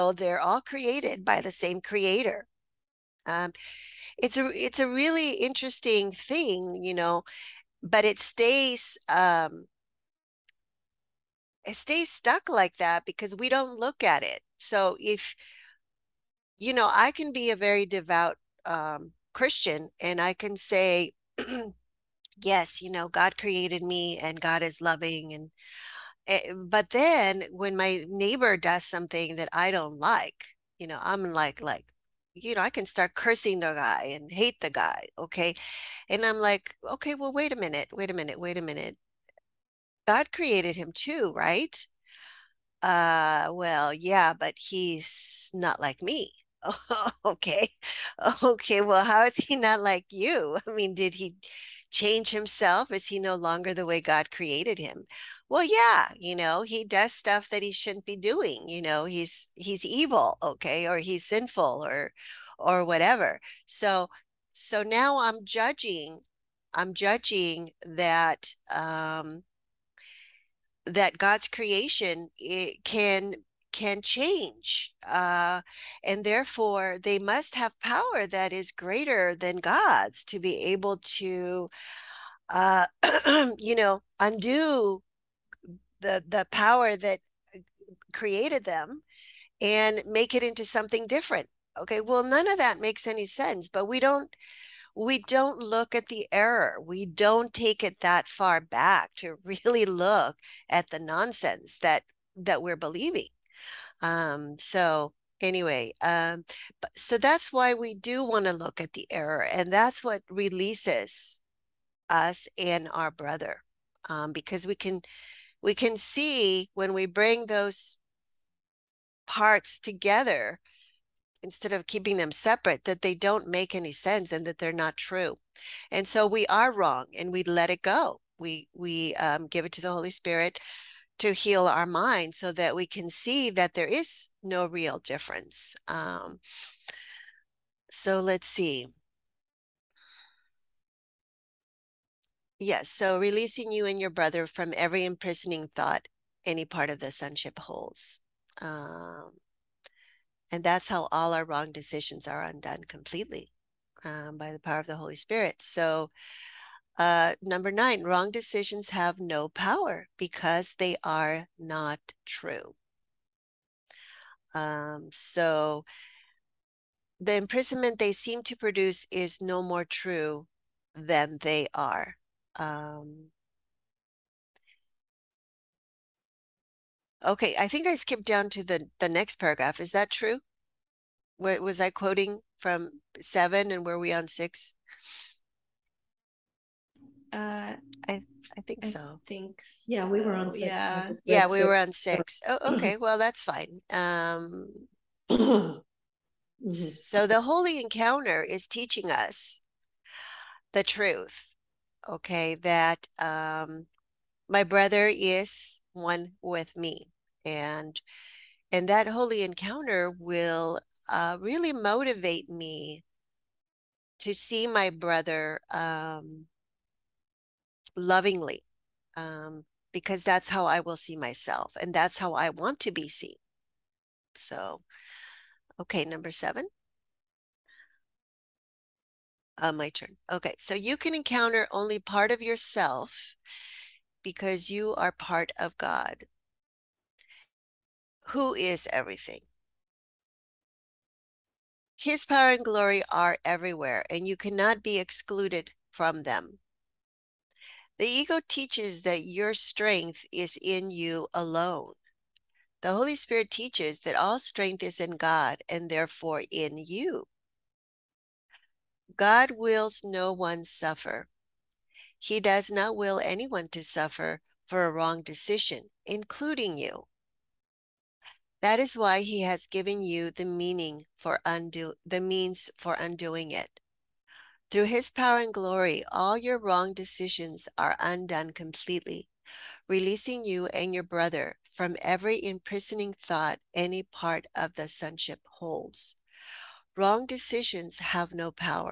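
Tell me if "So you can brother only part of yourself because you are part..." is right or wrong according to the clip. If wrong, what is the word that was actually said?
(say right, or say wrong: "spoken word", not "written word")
wrong: "encounter", not "brother".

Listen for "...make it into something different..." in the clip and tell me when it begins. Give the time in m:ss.
1:30.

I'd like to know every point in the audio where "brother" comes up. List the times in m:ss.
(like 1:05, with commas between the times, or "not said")
1:53, 2:24, 3:24, 3:34, 4:41.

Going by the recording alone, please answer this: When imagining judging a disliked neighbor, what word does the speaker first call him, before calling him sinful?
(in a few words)
evil.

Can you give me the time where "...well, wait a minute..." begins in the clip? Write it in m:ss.
0:37.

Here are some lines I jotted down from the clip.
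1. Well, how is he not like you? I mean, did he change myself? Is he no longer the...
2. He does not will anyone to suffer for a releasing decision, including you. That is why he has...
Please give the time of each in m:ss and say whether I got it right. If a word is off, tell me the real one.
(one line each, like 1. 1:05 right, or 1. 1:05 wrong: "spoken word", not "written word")
1. 0:48 wrong: "himself", not "myself"
2. 4:22 wrong: "wrong", not "releasing".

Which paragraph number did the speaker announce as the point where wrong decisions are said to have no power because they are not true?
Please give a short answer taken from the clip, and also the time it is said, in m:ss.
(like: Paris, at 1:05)
9, at 2:37.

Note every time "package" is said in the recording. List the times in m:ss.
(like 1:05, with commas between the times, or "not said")
not said.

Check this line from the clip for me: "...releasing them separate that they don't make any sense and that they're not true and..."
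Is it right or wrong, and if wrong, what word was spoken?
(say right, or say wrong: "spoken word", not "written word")
wrong: "keeping", not "releasing".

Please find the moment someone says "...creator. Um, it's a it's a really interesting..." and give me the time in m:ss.
0:01.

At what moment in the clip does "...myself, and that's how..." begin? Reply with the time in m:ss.
3:41.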